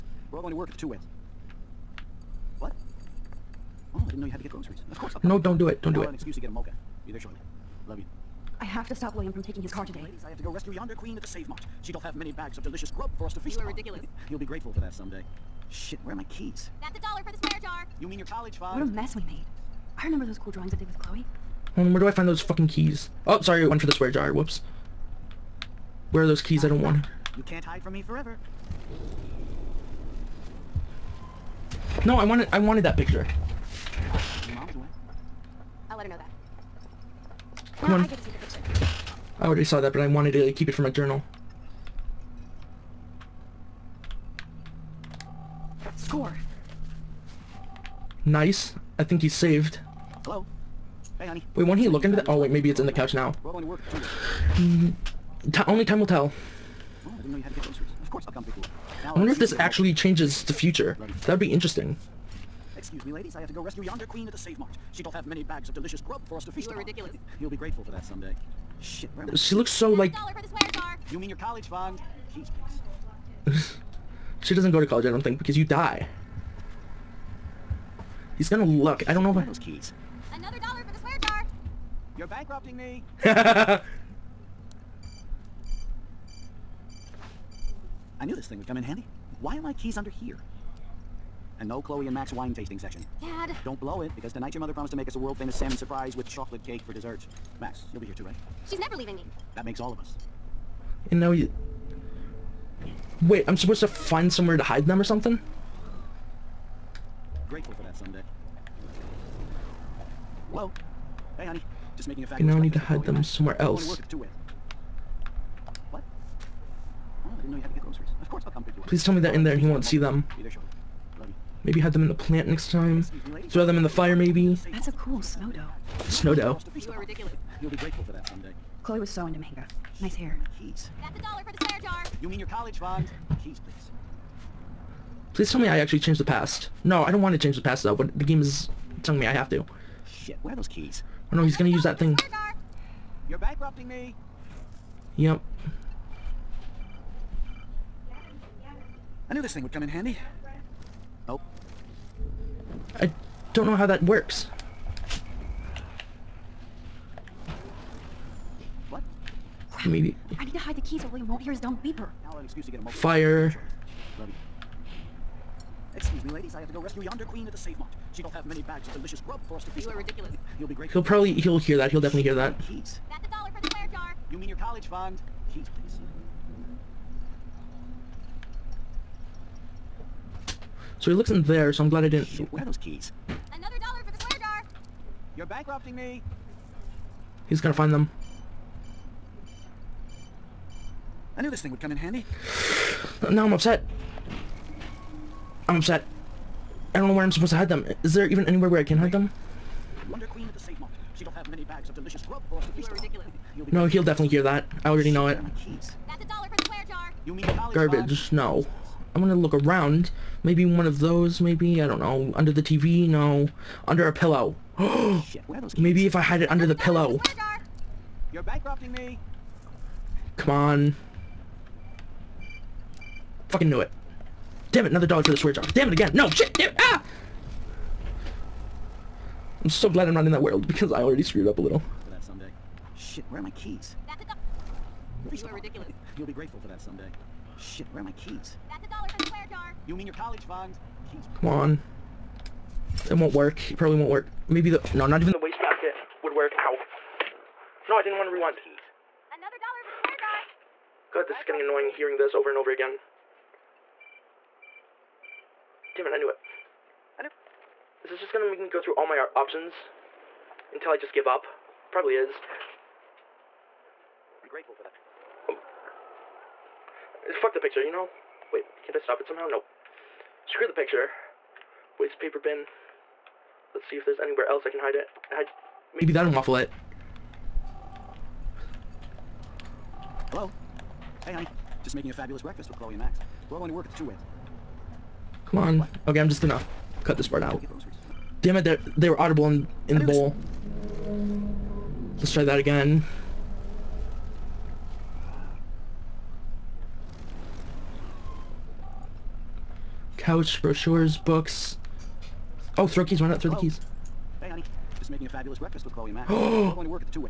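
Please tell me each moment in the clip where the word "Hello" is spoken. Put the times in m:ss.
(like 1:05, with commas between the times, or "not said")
0:50, 5:03.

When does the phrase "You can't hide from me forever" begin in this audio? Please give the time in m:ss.
0:27.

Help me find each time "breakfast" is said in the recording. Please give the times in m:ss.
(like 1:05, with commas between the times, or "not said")
4:42, 5:05.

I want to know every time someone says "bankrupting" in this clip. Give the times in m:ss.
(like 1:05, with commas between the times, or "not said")
1:22, 2:23, 3:05, 3:38.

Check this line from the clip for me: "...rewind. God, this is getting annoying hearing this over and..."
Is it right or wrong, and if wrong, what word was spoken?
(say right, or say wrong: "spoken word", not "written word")
right.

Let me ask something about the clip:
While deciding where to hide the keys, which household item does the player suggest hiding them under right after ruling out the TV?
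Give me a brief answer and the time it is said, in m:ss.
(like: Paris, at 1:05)
a pillow, at 3:34.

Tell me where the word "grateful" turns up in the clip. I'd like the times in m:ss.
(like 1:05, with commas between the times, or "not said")
0:14, 1:07, 1:47, 2:07, 3:56, 4:24.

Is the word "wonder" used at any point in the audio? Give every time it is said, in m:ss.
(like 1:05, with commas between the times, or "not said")
0:59, 3:20.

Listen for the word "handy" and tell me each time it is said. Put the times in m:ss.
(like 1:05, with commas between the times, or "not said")
1:28, 2:29, 3:11.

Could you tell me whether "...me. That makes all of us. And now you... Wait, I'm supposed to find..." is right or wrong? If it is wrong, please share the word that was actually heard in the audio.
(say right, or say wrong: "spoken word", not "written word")
right.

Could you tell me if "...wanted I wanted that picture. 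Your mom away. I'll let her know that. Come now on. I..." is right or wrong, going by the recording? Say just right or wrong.
right.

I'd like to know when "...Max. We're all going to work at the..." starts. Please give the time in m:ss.
4:42.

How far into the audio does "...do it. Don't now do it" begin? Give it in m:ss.
0:05.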